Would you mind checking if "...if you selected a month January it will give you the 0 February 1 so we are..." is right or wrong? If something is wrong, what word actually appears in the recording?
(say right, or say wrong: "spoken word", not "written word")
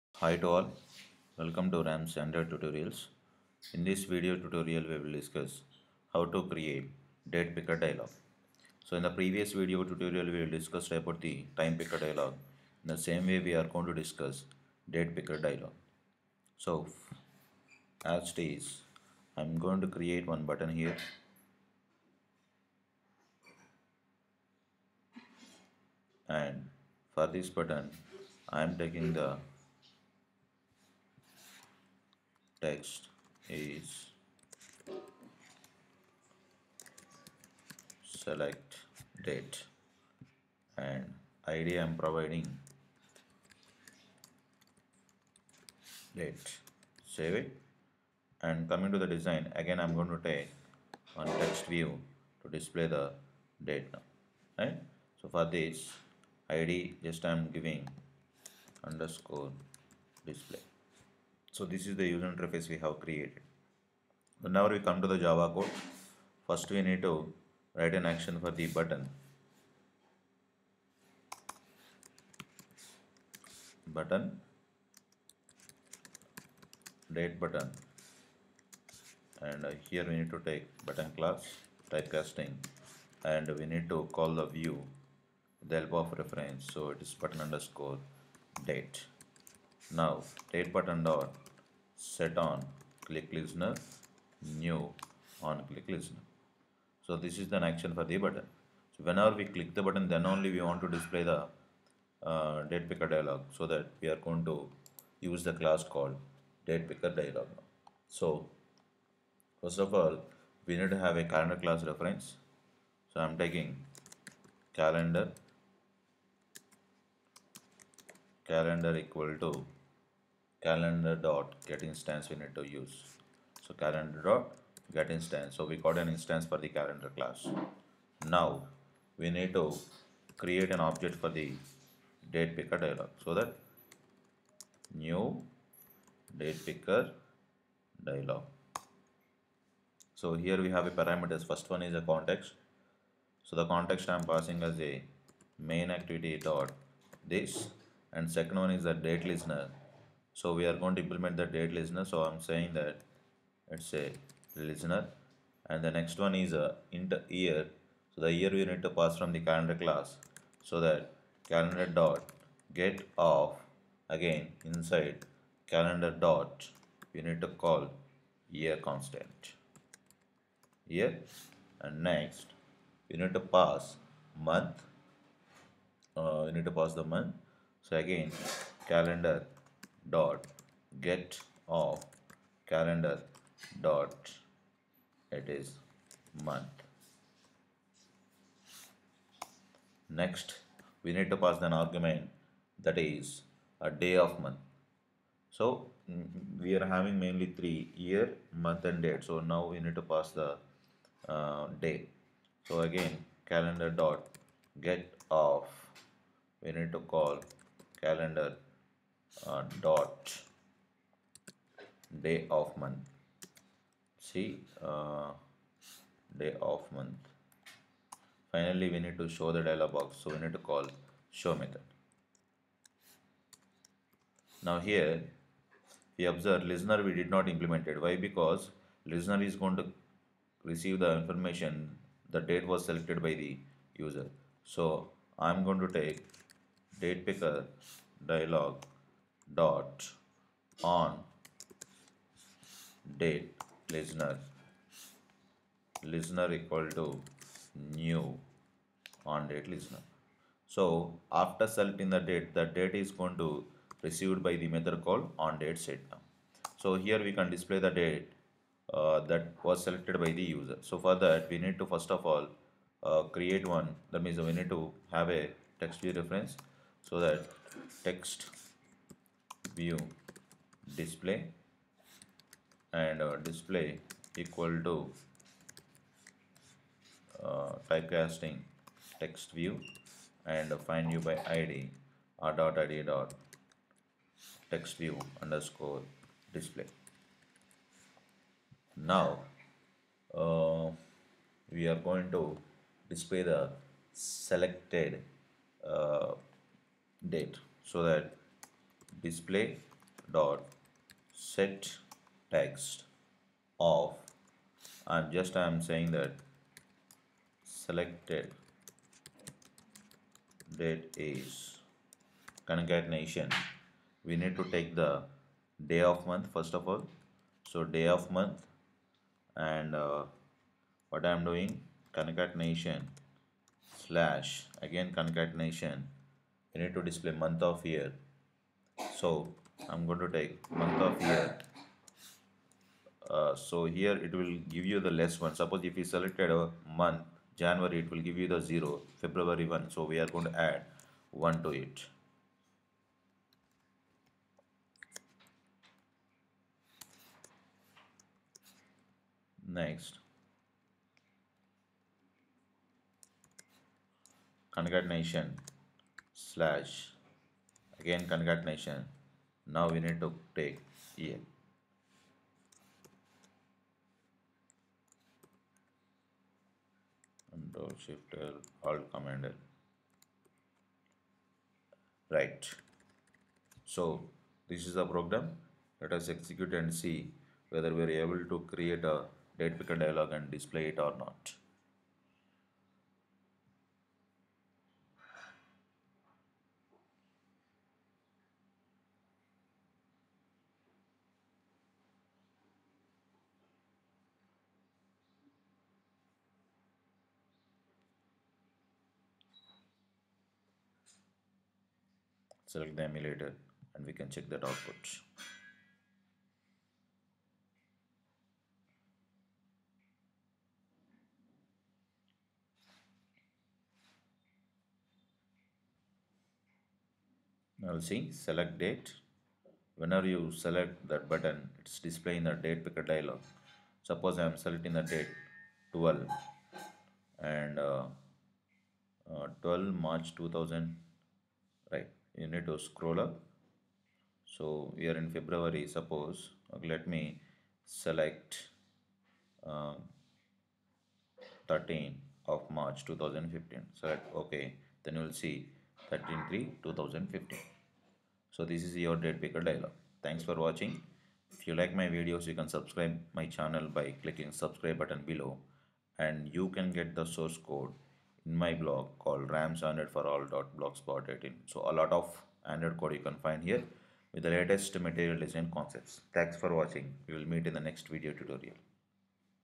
right.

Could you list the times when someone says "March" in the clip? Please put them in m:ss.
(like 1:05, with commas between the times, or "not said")
7:10, 7:22.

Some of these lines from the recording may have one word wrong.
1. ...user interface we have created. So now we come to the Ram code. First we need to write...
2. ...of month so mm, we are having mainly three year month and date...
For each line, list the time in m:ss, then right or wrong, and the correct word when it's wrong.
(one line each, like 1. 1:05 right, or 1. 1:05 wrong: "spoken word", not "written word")
1. 1:02 wrong: "Java", not "Ram"
2. 3:14 right.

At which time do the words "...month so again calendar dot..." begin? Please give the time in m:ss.
2:57.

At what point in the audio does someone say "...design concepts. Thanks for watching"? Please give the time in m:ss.
7:45.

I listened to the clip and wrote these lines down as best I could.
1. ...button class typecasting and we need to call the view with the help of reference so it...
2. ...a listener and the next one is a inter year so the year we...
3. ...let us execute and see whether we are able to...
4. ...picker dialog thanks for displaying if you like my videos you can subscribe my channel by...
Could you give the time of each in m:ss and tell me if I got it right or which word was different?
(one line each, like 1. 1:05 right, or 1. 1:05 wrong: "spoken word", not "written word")
1. 1:20 right
2. 2:33 right
3. 6:16 right
4. 7:29 wrong: "watching", not "displaying".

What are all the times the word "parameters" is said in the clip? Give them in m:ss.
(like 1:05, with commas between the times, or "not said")
2:21.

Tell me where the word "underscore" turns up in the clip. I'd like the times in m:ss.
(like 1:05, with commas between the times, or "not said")
0:58, 1:27, 4:45.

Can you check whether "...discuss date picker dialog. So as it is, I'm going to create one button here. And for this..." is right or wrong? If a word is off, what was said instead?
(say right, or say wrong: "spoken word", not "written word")
right.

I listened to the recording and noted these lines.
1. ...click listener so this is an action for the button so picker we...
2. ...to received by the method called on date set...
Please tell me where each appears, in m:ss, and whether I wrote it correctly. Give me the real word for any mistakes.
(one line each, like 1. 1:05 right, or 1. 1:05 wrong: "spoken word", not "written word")
1. 1:35 wrong: "whenever", not "picker"
2. 4:13 right.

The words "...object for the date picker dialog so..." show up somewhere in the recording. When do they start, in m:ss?
2:10.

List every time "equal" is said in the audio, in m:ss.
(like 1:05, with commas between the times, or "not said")
1:59, 4:06, 4:34.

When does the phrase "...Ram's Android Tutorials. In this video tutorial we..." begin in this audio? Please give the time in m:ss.
0:01.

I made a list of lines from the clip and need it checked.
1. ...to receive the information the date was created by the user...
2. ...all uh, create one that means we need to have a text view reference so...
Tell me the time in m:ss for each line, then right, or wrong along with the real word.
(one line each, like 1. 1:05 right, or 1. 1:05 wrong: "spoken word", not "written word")
1. 3:49 wrong: "selected", not "created"
2. 4:22 right.